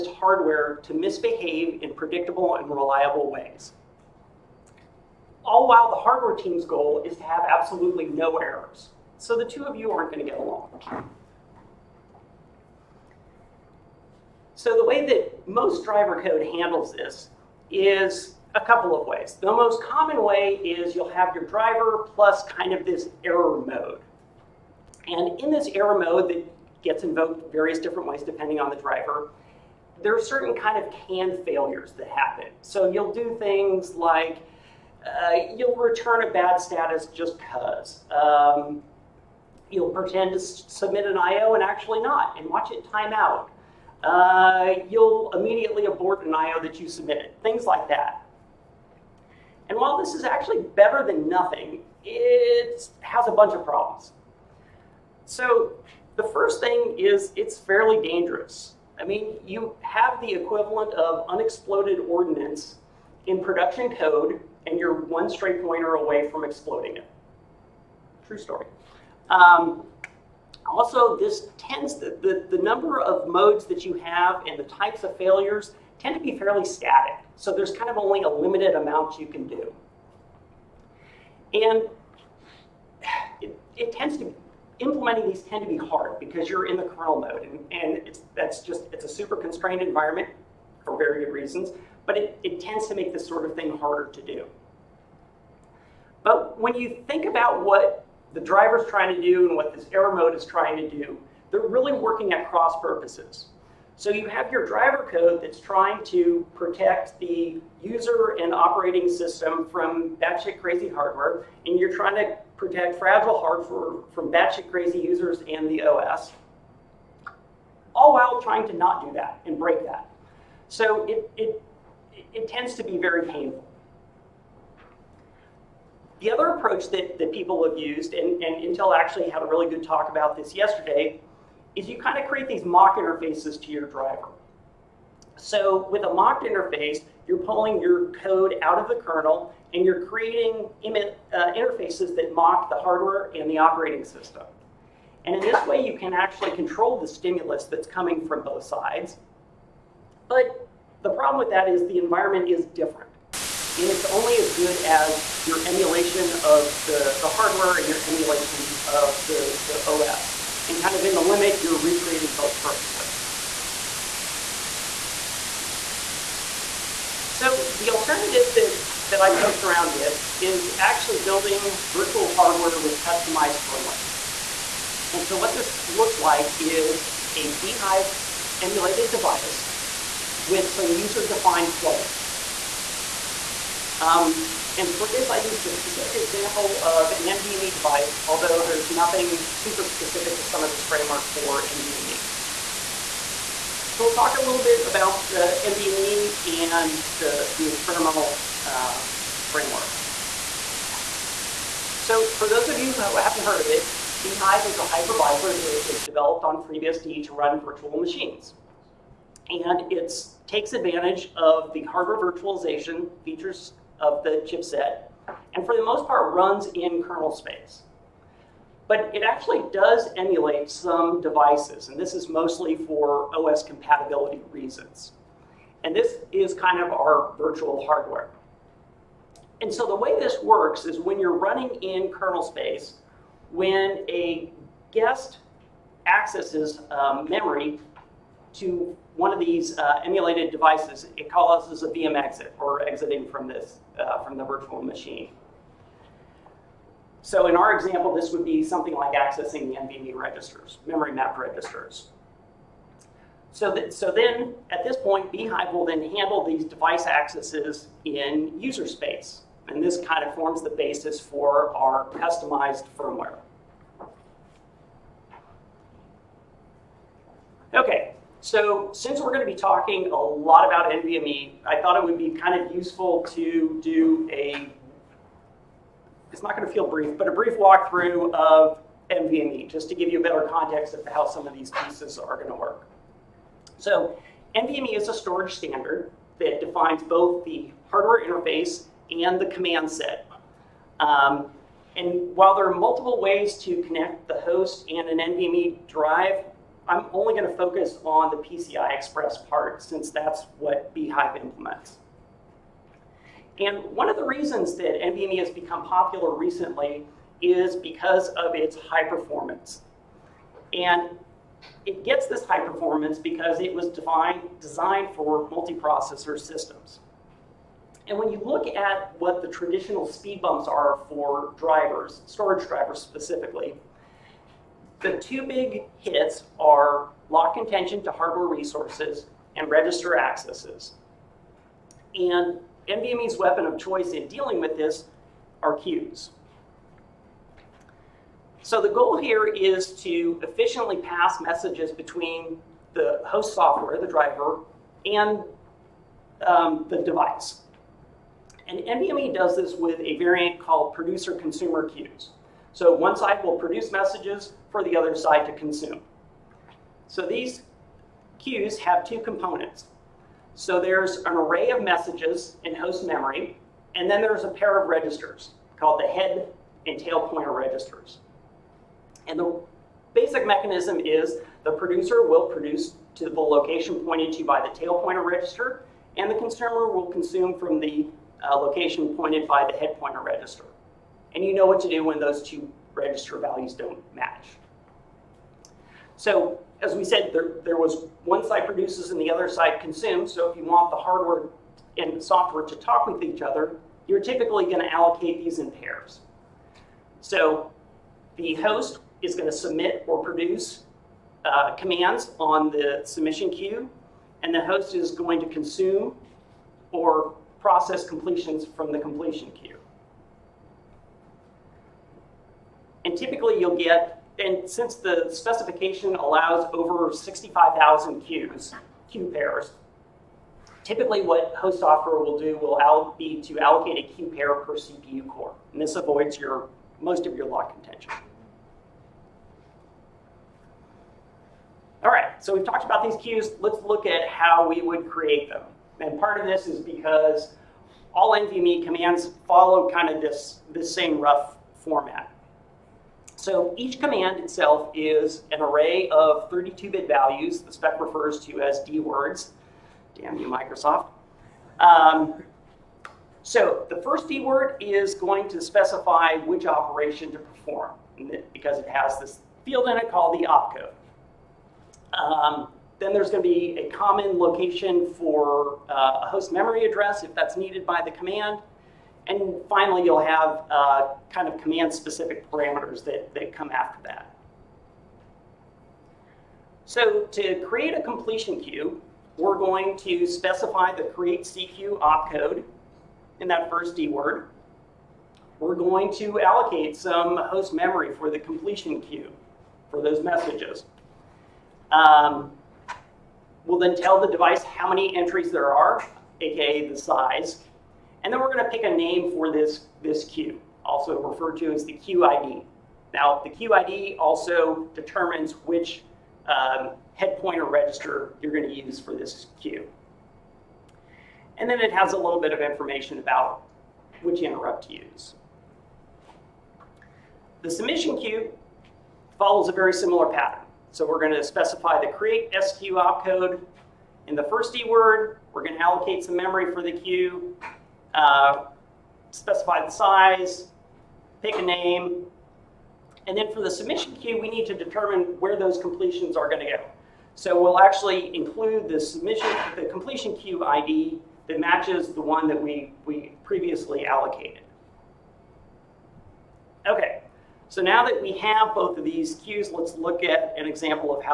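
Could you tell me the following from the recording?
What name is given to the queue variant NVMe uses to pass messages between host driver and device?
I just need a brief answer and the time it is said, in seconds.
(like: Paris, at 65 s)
producer-consumer queues, at 350 s.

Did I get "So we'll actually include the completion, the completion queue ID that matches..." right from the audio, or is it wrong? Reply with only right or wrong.
wrong.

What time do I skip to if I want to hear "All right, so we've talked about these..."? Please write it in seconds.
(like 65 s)
432 s.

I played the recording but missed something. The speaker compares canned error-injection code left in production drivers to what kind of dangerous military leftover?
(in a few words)
unexploded ordnance.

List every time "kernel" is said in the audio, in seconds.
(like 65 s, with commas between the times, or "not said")
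86 s, 139 s, 217 s, 232 s.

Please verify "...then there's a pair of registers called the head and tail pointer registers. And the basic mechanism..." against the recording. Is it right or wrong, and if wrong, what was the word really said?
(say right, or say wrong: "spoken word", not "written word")
right.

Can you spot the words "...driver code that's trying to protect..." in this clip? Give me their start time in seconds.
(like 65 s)
104 s.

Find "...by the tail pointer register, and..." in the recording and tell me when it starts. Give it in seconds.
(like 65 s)
374 s.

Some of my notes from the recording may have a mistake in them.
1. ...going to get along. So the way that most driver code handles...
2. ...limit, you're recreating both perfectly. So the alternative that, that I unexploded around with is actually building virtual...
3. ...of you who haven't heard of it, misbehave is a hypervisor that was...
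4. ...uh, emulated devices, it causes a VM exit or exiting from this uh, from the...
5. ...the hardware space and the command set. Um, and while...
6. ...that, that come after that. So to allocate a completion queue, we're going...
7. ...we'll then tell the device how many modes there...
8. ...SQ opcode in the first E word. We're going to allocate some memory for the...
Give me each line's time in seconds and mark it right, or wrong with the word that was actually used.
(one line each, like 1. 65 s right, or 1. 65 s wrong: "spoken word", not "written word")
1. 10 s right
2. 161 s wrong: "poked", not "unexploded"
3. 202 s wrong: "bhyve", not "misbehave"
4. 239 s right
5. 287 s wrong: "interface", not "space"
6. 473 s wrong: "create", not "allocate"
7. 493 s wrong: "entries", not "modes"
8. 522 s right.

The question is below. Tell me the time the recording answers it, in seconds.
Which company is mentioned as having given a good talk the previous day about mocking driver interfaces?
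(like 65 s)
128 s.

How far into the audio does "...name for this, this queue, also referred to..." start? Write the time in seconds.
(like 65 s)
498 s.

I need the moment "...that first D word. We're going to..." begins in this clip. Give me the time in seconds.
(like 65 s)
483 s.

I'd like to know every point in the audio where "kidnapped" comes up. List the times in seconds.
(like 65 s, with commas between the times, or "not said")
not said.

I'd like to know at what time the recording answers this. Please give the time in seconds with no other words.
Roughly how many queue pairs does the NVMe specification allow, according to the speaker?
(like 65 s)
416 s.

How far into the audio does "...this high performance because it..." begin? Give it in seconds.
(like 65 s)
312 s.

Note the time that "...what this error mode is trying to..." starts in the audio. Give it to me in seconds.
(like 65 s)
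99 s.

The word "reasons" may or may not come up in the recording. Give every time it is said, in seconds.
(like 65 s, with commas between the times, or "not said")
91 s, 224 s, 304 s.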